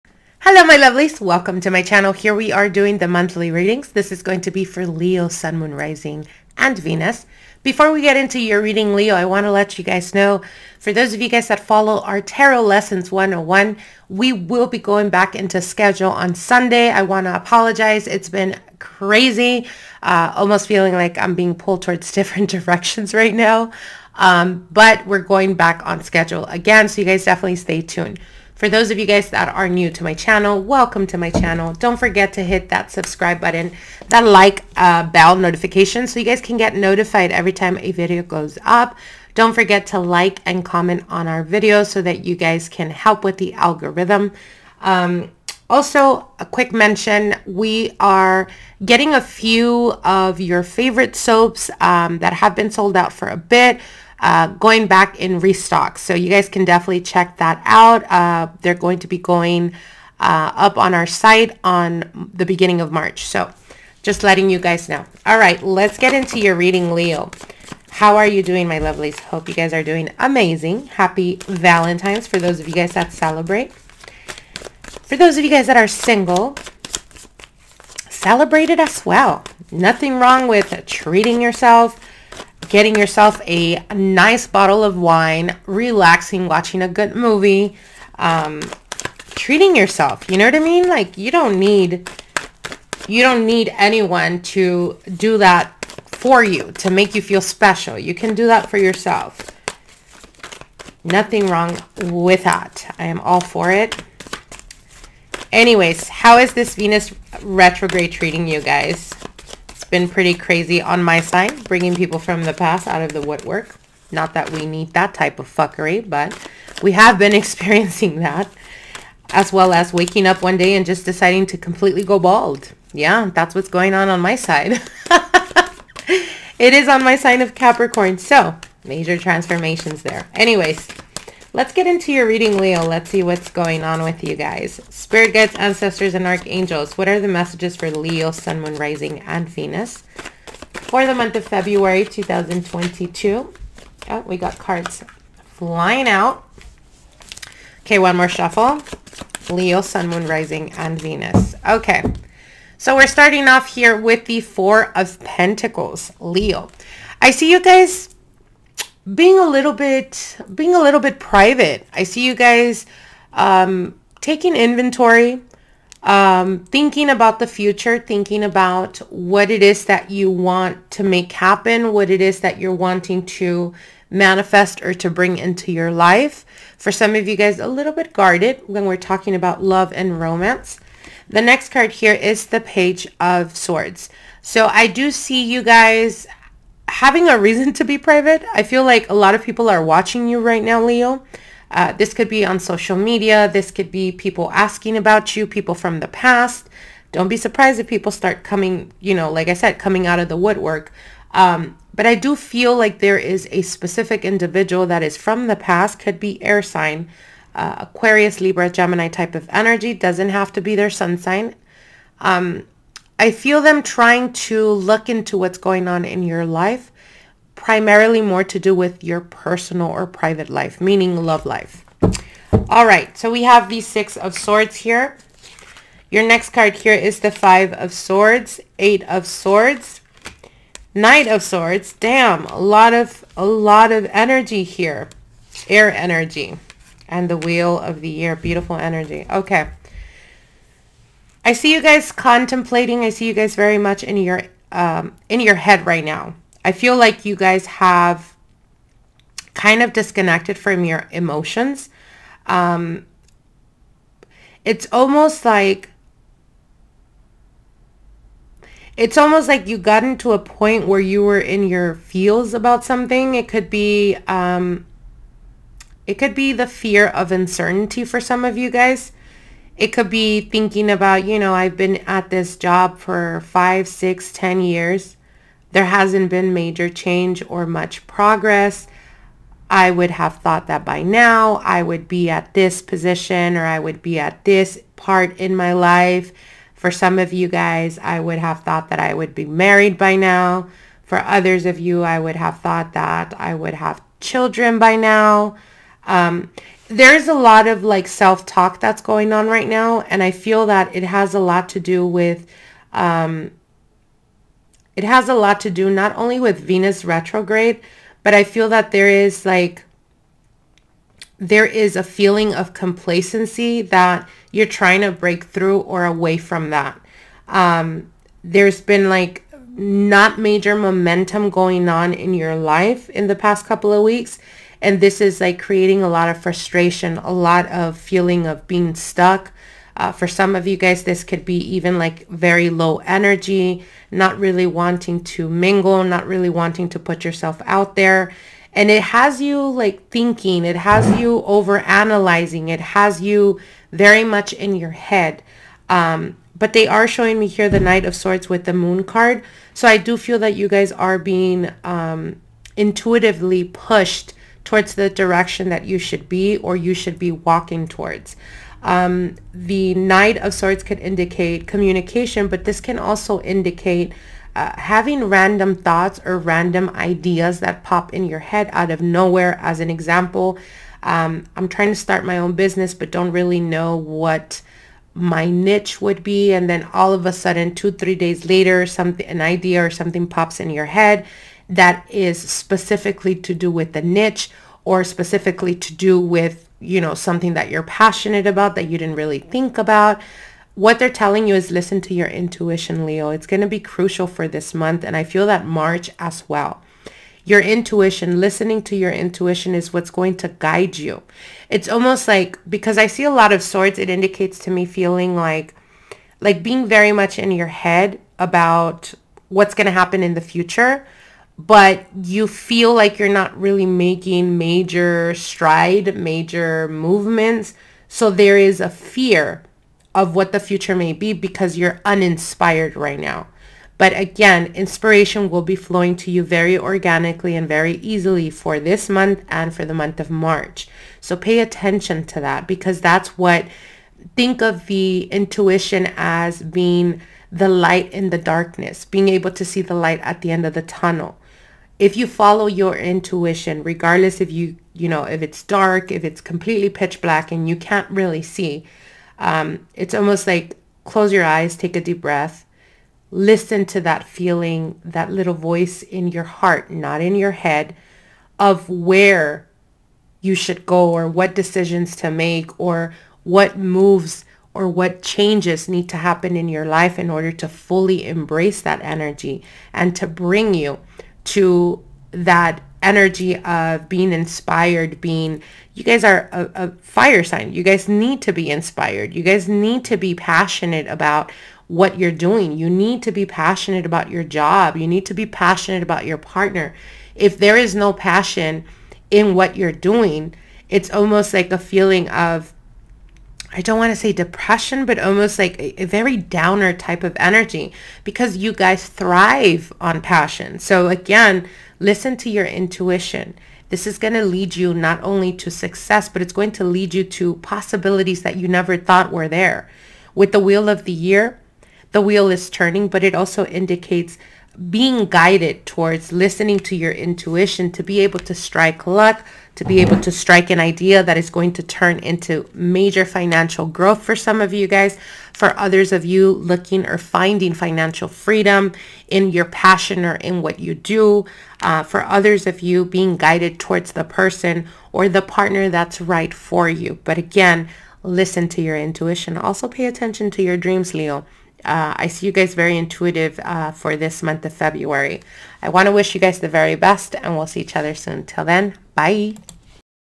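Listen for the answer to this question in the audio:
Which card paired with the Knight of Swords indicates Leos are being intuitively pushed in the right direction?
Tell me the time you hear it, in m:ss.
5:48.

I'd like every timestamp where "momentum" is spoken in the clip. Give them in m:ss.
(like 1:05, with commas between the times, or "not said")
5:20.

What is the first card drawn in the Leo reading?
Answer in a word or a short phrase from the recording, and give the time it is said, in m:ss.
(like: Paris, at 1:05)
Four of Pentacles, at 2:34.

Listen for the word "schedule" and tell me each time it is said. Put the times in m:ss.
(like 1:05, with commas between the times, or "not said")
0:15, 0:26.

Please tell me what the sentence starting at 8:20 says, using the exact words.
So again, listen to your intuition.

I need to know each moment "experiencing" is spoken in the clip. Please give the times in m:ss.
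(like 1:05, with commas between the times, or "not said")
1:57.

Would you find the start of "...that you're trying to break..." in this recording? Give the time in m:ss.
5:13.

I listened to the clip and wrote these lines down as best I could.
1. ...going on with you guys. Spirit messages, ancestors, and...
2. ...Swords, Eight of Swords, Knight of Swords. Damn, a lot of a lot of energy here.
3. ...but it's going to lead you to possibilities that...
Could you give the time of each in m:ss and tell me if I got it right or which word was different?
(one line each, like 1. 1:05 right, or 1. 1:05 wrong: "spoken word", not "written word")
1. 2:13 wrong: "guides", not "messages"
2. 3:47 right
3. 8:26 right.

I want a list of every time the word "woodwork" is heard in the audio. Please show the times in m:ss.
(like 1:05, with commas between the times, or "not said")
1:53, 3:20.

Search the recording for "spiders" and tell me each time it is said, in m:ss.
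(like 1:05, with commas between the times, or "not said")
not said.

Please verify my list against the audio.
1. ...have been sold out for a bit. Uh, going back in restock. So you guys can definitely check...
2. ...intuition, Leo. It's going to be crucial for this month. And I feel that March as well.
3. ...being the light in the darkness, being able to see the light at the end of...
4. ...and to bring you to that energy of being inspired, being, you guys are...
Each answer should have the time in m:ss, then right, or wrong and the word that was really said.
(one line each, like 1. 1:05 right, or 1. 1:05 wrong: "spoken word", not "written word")
1. 0:52 right
2. 6:32 right
3. 7:16 right
4. 7:49 right.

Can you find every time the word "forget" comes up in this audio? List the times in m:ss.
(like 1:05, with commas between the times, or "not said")
0:31, 0:39.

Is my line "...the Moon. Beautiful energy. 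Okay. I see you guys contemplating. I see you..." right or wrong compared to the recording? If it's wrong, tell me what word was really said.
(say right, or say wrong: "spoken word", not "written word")
wrong: "Year", not "Moon".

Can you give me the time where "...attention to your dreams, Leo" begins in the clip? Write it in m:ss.
9:00.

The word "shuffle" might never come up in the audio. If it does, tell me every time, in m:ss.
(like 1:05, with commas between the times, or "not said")
2:28.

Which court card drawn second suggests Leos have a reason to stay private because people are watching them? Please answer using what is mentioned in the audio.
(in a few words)
Page of Swords.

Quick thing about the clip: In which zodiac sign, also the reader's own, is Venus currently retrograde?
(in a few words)
Capricorn.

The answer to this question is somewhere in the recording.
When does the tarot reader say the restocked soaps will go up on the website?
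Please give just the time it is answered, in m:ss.
1:02.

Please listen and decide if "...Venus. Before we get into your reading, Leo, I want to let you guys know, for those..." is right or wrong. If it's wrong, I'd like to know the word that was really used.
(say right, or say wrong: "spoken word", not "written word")
right.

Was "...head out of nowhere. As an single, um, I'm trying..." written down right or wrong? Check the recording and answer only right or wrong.
wrong.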